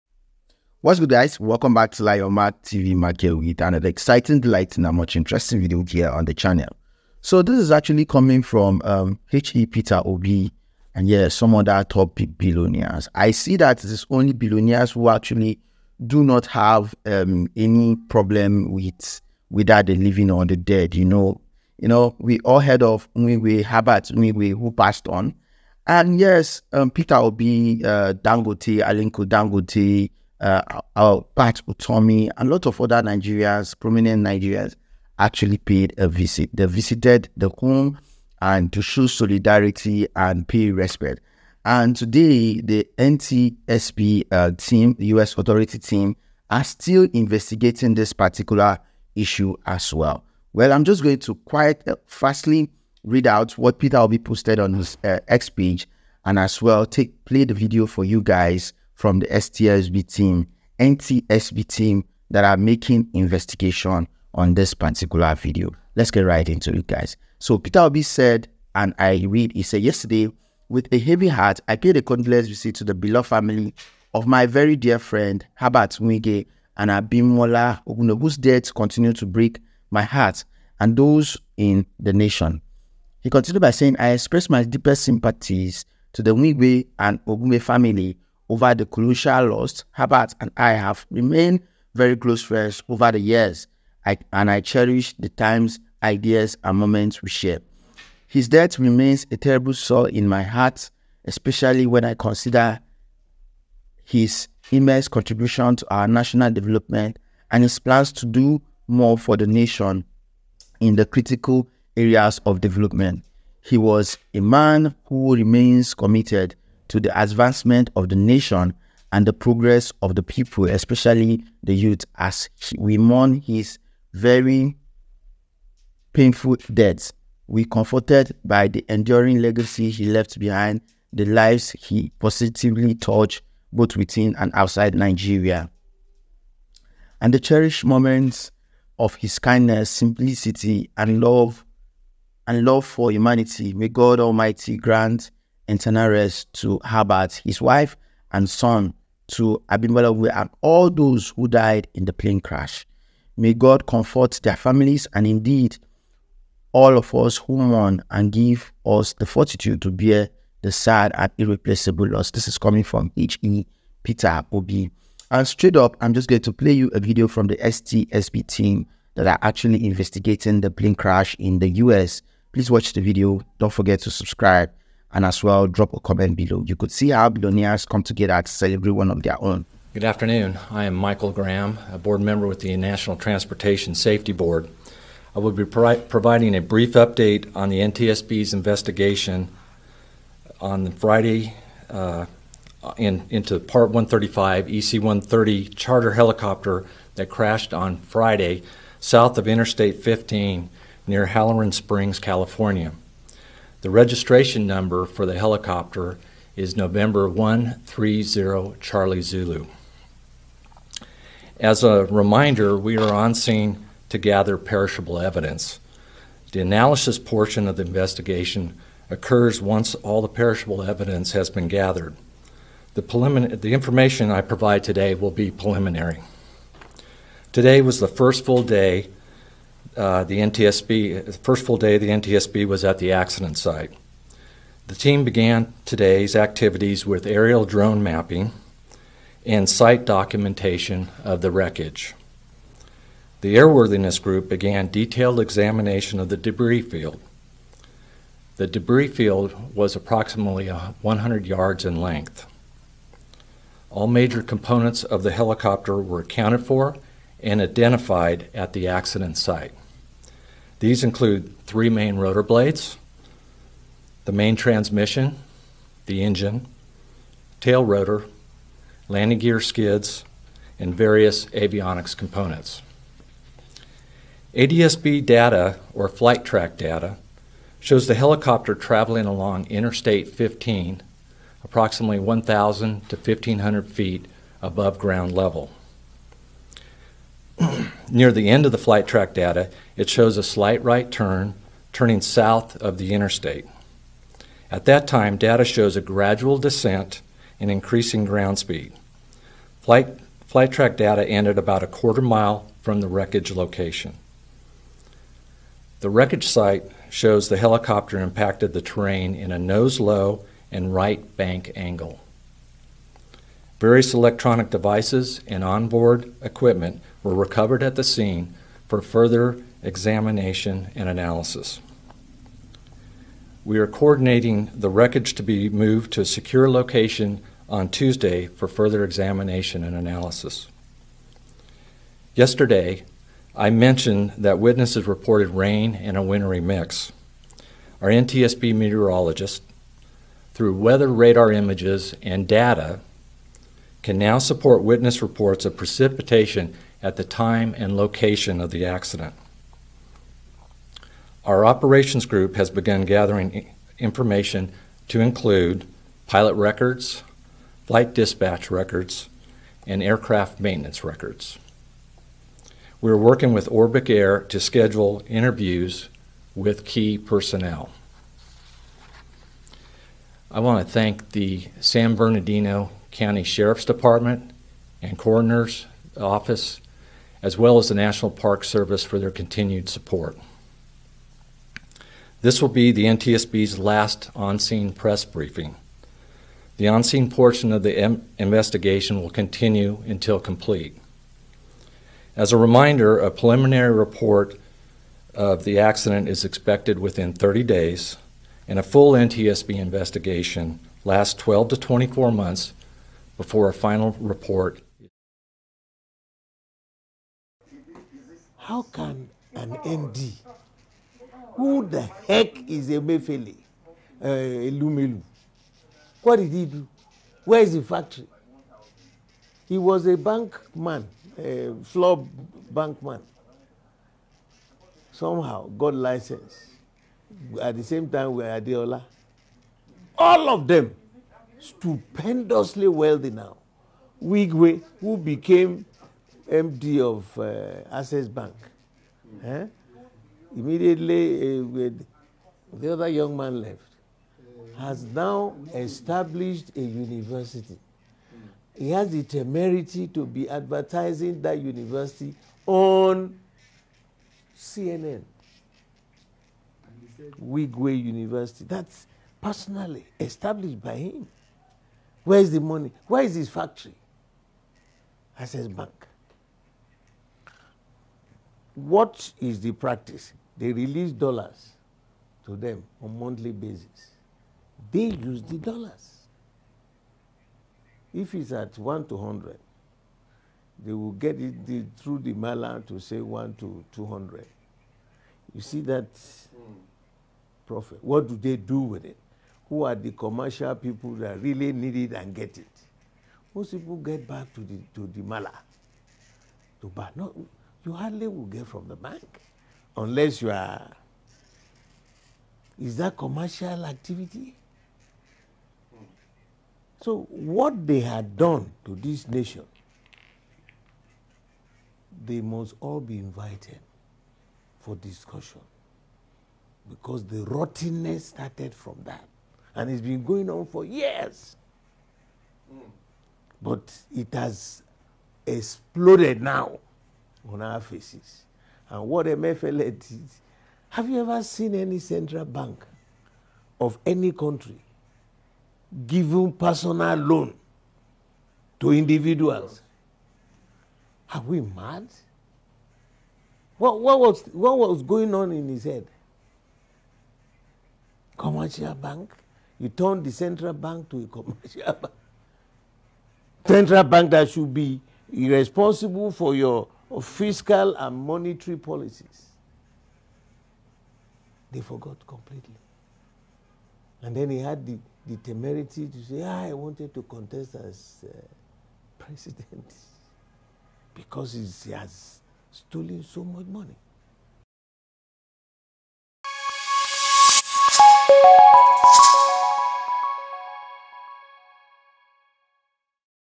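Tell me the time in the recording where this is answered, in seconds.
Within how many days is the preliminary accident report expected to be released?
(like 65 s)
397 s.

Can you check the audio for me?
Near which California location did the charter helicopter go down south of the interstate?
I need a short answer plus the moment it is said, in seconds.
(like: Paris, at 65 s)
Halloran Springs, at 201 s.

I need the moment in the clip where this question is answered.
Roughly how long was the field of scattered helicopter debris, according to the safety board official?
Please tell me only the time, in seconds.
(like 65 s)
251 s.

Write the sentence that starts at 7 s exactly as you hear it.
So this is actually coming from um, H.E.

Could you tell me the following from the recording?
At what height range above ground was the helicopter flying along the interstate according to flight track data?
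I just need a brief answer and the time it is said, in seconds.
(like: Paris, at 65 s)
1,000 to 1,500 feet, at 282 s.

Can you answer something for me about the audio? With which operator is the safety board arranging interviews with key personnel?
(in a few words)
Orbic Air.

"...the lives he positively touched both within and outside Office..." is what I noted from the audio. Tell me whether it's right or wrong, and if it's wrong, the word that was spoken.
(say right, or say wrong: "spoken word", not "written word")
wrong: "Nigeria", not "Office".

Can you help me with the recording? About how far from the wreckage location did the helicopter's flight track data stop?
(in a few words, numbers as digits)
a quarter mile.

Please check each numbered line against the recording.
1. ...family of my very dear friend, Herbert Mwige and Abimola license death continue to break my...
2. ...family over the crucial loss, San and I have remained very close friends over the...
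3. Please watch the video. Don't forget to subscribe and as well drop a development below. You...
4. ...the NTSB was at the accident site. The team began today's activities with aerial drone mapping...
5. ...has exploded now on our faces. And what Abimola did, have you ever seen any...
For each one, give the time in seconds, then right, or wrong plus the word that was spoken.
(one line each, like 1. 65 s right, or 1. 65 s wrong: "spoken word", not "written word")
1. 73 s wrong: "whose", not "license"
2. 87 s wrong: "Herbert", not "San"
3. 172 s wrong: "comment", not "development"
4. 231 s right
5. 524 s wrong: "MFL", not "Abimola".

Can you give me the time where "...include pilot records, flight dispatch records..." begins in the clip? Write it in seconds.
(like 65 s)
355 s.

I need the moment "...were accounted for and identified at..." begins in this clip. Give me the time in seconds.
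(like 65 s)
255 s.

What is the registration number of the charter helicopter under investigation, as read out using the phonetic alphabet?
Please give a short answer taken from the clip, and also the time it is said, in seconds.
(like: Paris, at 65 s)
N130CZ, at 206 s.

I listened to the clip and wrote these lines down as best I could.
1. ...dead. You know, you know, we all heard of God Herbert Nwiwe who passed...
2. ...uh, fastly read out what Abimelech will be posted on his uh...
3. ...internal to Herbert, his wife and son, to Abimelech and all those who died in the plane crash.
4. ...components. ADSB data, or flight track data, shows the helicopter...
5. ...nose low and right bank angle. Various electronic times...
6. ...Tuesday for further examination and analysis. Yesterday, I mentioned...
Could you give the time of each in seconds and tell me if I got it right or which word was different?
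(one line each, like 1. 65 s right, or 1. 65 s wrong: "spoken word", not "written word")
1. 20 s wrong: "Nwiwe", not "God"
2. 51 s wrong: "Peter", not "Abimelech"
3. 145 s right
4. 272 s right
5. 309 s wrong: "devices", not "times"
6. 327 s right.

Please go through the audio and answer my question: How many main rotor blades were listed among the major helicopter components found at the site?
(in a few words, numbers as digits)
3.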